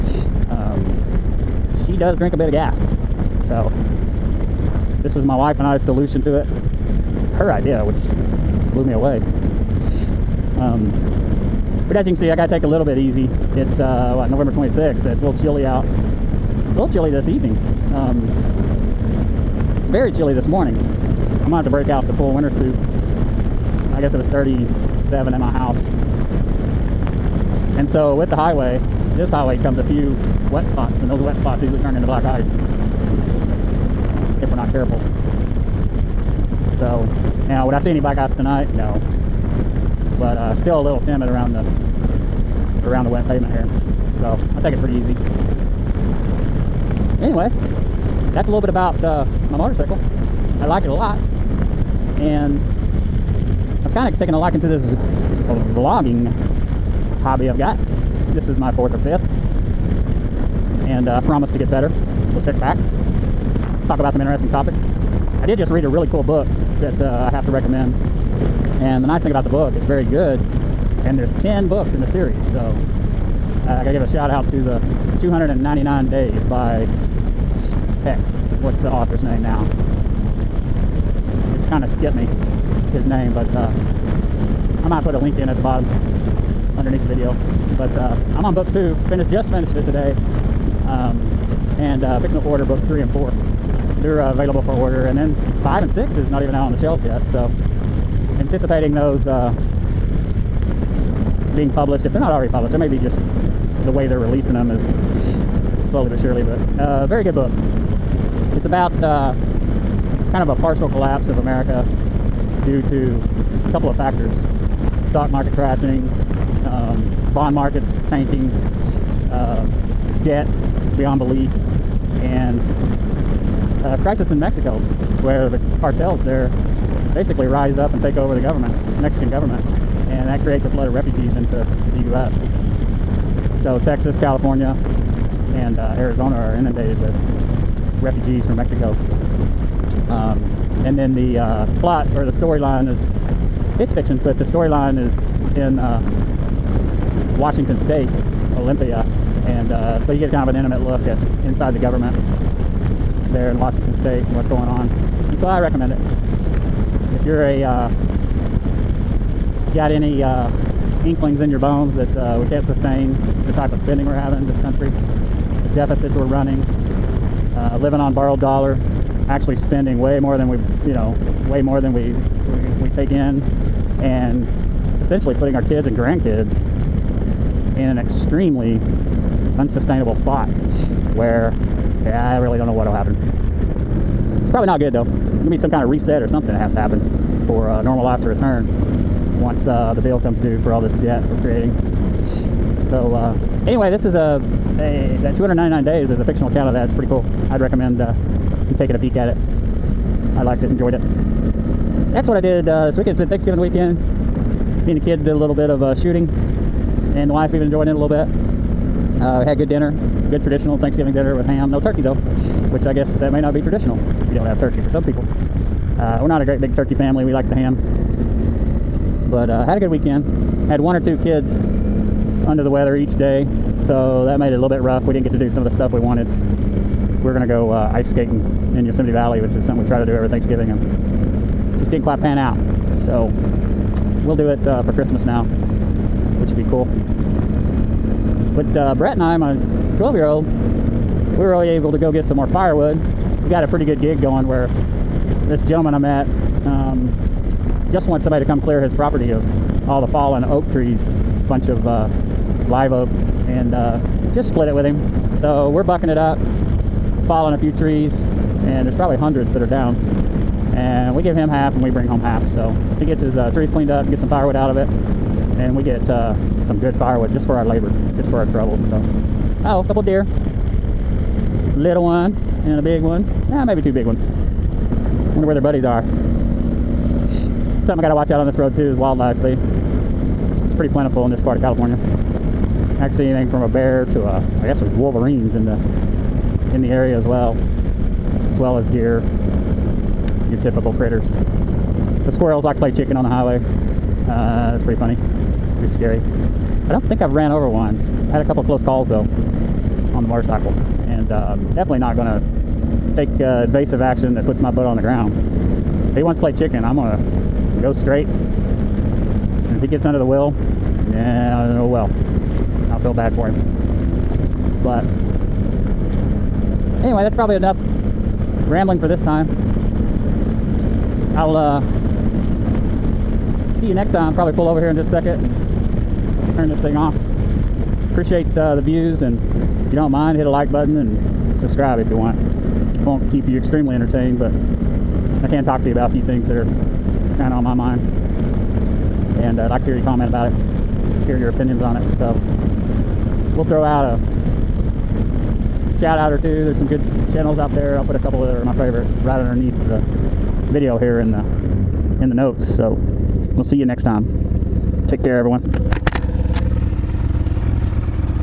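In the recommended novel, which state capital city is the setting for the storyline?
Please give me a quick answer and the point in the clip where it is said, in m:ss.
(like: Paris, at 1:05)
Olympia, at 2:28.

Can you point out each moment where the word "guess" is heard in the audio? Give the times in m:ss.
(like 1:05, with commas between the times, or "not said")
0:24, 3:32, 4:44.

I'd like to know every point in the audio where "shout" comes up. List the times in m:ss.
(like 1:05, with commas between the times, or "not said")
1:14, 5:45.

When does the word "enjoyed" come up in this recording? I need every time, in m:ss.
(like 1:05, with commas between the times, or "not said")
3:20, 3:27.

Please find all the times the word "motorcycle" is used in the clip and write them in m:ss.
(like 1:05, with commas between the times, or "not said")
0:49, 5:00.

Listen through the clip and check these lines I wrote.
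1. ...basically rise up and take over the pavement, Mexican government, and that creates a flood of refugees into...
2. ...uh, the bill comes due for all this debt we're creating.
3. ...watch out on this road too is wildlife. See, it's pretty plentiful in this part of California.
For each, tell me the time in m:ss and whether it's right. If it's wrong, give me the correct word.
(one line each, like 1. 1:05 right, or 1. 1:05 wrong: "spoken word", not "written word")
1. 2:07 wrong: "government", not "pavement"
2. 3:09 right
3. 4:38 right.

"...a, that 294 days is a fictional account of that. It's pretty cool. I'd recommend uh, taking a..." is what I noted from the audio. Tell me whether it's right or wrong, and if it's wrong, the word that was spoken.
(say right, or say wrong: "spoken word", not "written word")
wrong: "299", not "294".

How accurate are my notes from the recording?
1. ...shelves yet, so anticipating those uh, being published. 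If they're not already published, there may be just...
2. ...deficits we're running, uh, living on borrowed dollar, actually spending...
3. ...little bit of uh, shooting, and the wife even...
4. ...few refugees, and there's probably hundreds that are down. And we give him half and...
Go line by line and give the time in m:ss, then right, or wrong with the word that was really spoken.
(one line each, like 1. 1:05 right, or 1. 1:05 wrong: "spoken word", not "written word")
1. 1:36 right
2. 2:45 right
3. 3:25 right
4. 4:17 wrong: "trees", not "refugees".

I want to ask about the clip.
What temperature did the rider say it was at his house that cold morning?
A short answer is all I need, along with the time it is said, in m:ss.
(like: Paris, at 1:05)
37, at 0:24.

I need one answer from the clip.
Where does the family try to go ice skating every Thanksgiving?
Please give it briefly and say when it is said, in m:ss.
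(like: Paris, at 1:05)
Yosemite Valley, at 3:48.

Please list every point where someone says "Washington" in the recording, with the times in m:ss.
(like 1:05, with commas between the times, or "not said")
2:27, 2:33.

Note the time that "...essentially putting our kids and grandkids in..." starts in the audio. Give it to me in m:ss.
2:54.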